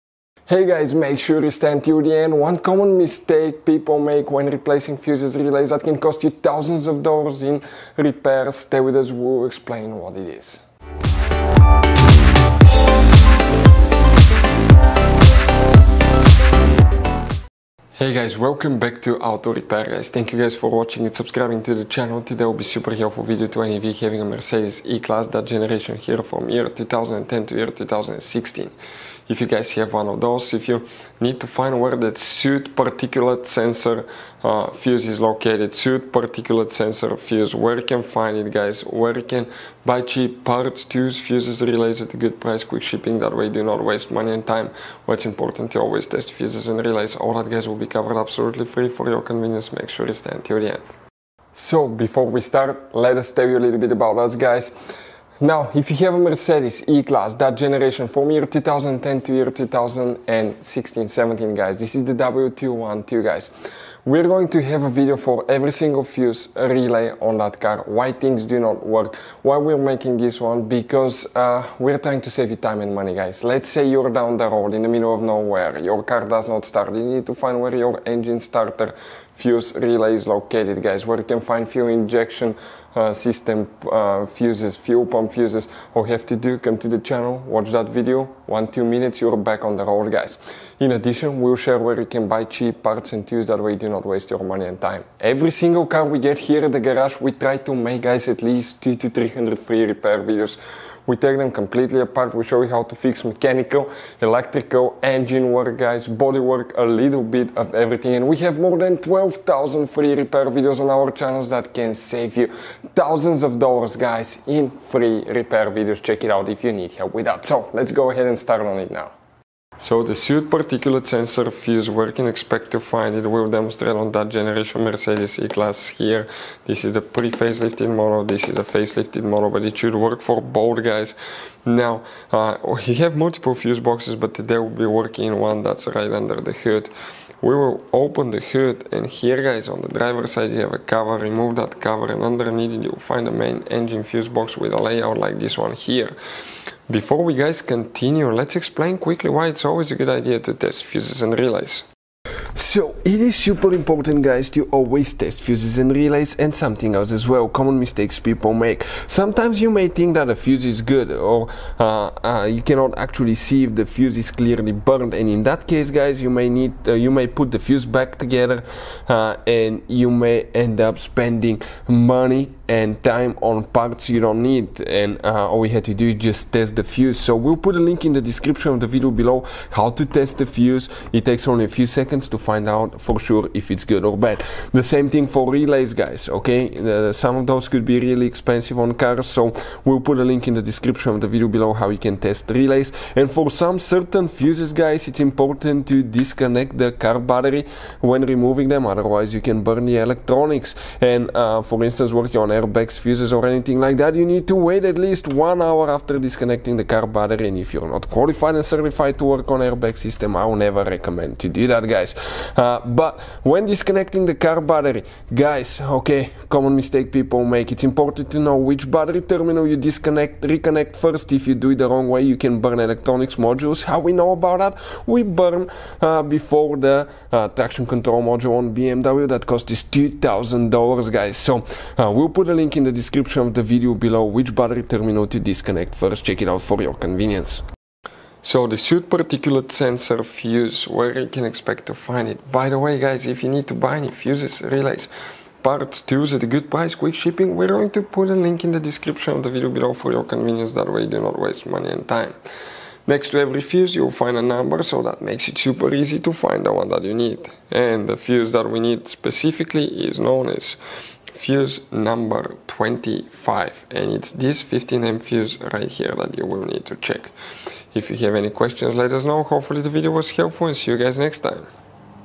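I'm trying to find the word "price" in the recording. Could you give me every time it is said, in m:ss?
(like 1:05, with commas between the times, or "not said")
0:42, 4:06.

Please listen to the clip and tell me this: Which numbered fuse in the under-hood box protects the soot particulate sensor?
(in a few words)
25.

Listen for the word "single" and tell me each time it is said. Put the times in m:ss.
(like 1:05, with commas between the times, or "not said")
1:05, 1:35.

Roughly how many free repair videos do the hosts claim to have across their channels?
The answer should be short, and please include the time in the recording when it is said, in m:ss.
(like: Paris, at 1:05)
12,000, at 1:48.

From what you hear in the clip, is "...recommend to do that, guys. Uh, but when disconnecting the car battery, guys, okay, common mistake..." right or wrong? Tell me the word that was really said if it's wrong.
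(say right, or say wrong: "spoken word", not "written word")
right.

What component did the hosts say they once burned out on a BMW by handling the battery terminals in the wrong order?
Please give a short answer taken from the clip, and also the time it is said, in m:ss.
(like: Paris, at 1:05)
traction control module, at 3:47.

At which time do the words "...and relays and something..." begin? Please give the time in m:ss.
2:35.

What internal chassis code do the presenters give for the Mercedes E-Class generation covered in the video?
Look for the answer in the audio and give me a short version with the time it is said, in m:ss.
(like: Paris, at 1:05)
W212, at 1:02.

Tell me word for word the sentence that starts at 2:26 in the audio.
Before we guys continue, let's explain quickly why it's always a good idea to test fuses and relays.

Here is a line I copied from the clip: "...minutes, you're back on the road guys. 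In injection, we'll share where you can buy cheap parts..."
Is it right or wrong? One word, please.
wrong.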